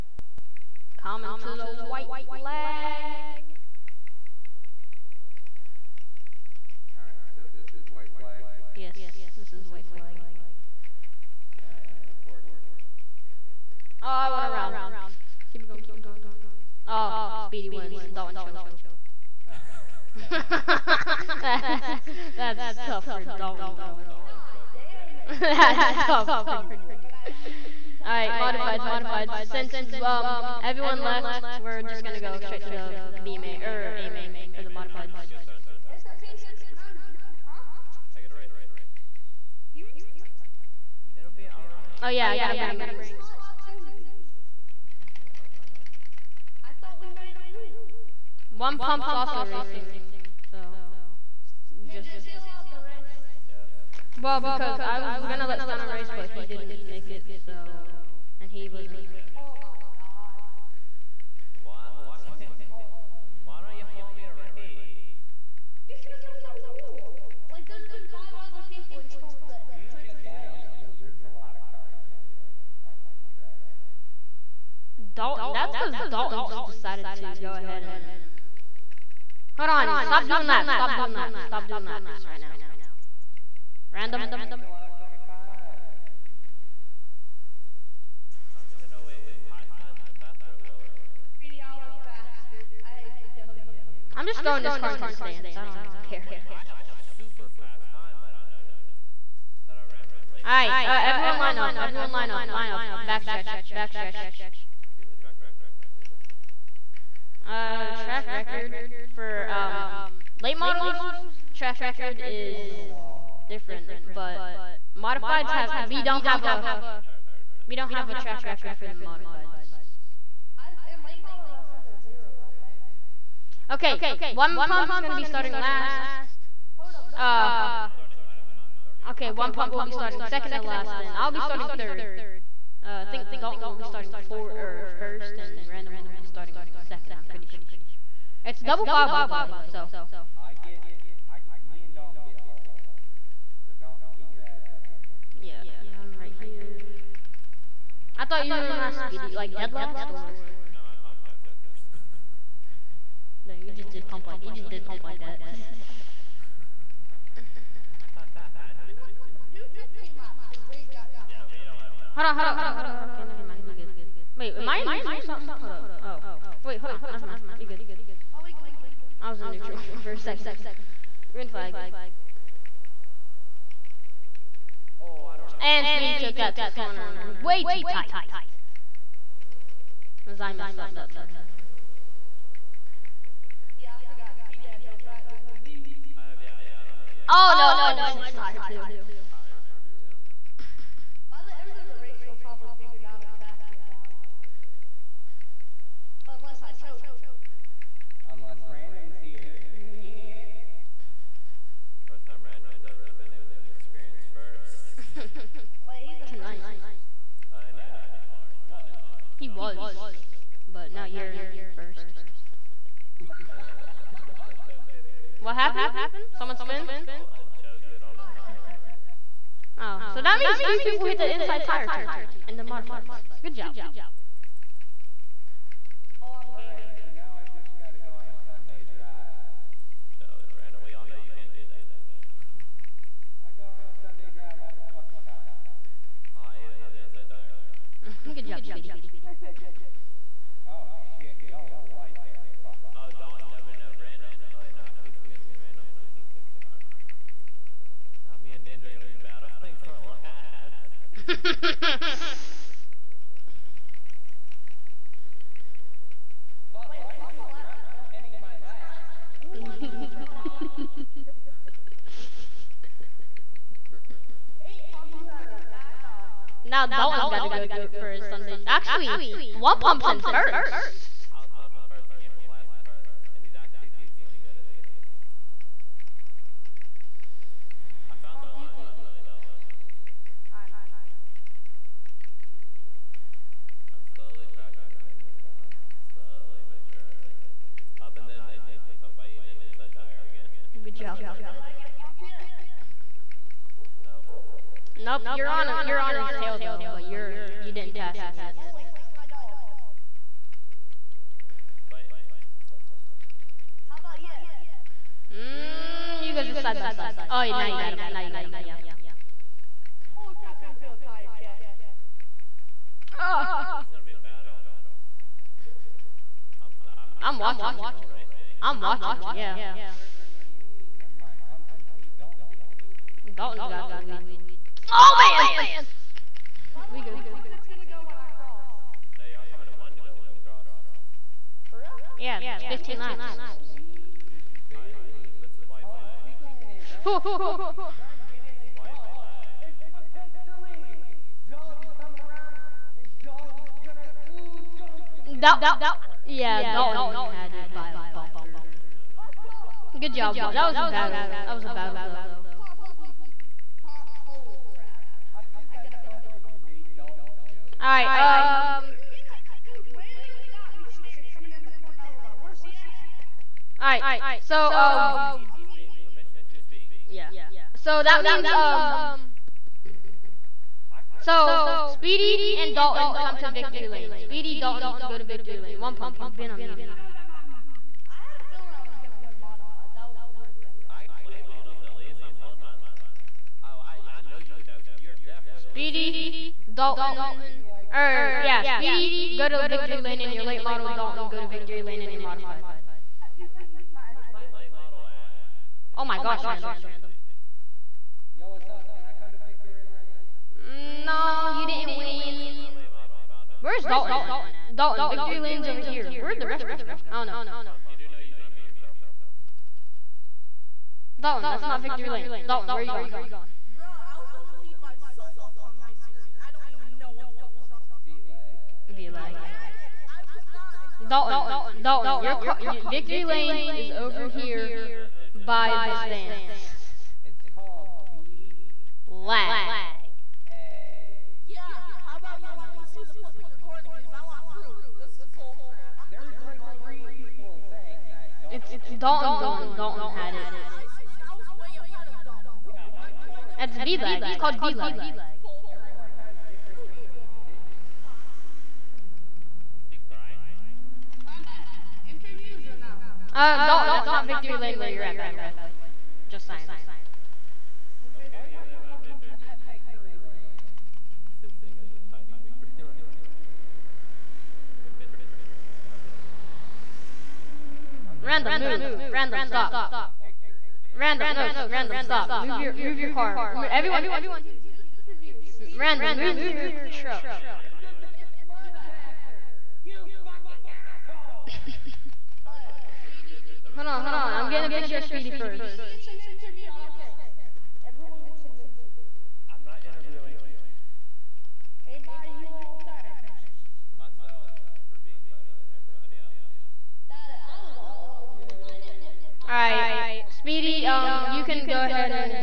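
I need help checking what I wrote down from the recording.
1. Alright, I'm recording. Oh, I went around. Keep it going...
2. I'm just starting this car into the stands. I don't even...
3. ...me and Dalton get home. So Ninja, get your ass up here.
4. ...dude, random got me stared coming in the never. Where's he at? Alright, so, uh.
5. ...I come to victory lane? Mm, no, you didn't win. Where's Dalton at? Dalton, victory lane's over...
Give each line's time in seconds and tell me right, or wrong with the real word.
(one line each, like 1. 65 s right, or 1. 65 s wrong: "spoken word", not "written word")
1. 11 s right
2. 94 s wrong: "throwing", not "starting"
3. 141 s wrong: "Dalton", not "Ninja"
4. 359 s wrong: "corner", not "never"
5. 399 s right.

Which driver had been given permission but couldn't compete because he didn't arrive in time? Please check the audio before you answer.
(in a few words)
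Stunner.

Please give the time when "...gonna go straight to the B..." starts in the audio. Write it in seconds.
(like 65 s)
32 s.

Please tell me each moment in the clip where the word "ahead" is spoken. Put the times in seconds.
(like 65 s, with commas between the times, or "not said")
77 s, 441 s, 501 s.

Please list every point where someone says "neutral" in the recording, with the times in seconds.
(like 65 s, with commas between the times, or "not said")
164 s, 169 s.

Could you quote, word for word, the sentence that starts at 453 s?
Uh, Dalton, that's not victory lane where you're at, by the way.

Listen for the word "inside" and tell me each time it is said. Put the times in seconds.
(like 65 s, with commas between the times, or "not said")
221 s, 289 s.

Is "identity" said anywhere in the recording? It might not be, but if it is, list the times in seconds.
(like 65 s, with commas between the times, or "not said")
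not said.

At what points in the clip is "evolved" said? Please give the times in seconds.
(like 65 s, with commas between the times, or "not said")
not said.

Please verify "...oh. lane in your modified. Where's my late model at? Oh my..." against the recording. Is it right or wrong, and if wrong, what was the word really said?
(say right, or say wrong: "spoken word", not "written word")
right.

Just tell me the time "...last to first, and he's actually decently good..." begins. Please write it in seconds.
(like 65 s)
272 s.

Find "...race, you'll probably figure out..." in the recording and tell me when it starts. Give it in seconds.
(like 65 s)
192 s.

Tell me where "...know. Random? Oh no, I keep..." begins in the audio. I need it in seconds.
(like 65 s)
243 s.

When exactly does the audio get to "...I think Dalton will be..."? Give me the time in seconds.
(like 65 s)
133 s.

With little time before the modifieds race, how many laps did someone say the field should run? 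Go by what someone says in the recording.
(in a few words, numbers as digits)
15.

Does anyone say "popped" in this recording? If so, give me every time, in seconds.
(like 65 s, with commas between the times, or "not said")
not said.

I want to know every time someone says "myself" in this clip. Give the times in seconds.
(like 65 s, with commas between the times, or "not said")
288 s, 493 s.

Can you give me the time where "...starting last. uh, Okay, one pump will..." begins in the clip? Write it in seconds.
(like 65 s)
125 s.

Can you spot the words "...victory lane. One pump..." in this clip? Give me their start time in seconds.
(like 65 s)
375 s.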